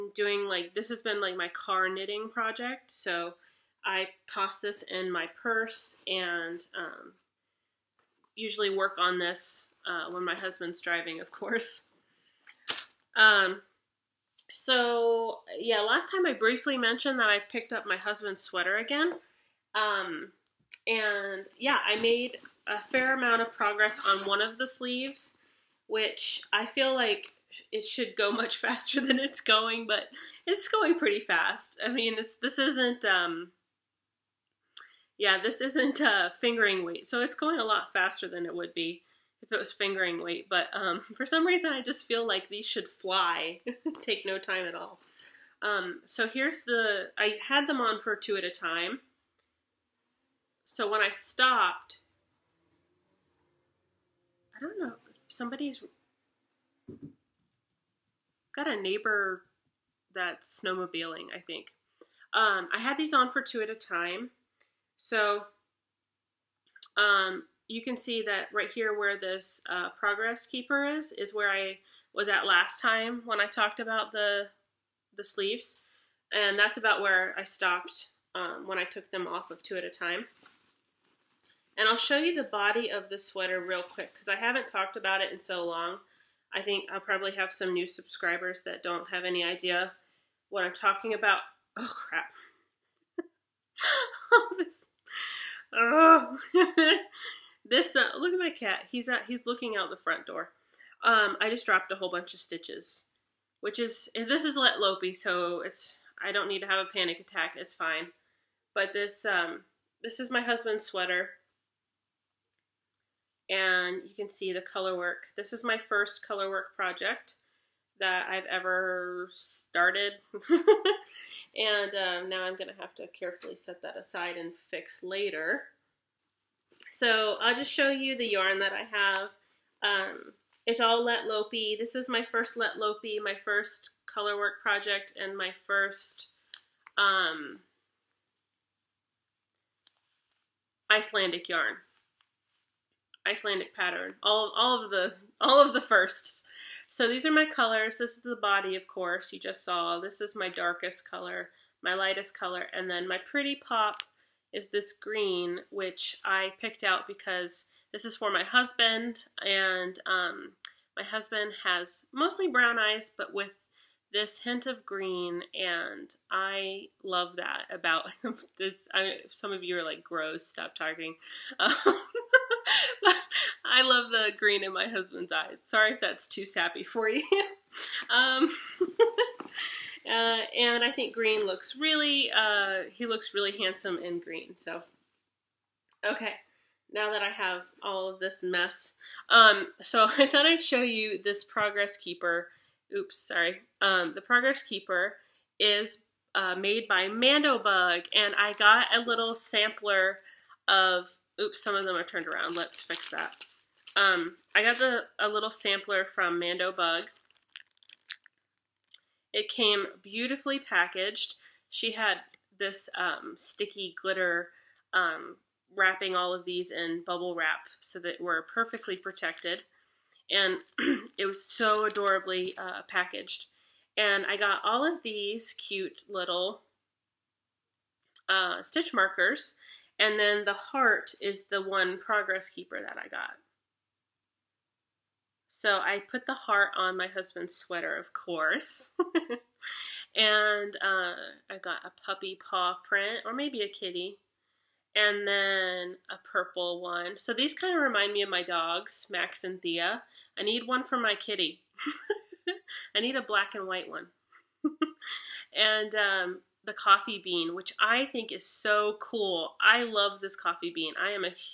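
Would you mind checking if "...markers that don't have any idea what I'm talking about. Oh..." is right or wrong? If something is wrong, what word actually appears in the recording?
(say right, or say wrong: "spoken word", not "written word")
wrong: "subscribers", not "markers".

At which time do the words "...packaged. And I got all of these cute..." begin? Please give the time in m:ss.
3:42.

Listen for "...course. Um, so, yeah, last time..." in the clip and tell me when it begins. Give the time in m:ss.
0:11.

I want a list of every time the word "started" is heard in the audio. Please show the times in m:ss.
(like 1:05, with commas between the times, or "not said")
1:59.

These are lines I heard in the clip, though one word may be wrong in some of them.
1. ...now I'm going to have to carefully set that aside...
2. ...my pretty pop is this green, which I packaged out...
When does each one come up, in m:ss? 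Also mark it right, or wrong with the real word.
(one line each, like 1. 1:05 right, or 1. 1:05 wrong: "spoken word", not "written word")
1. 2:02 right
2. 2:33 wrong: "picked", not "packaged".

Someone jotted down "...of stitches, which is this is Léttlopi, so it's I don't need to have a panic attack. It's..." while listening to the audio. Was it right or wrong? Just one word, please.
right.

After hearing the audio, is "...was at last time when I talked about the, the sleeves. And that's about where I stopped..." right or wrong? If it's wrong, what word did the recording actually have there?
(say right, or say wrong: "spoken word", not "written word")
right.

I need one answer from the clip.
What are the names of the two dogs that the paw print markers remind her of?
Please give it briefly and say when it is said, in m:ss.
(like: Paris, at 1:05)
Max and Thea, at 4:09.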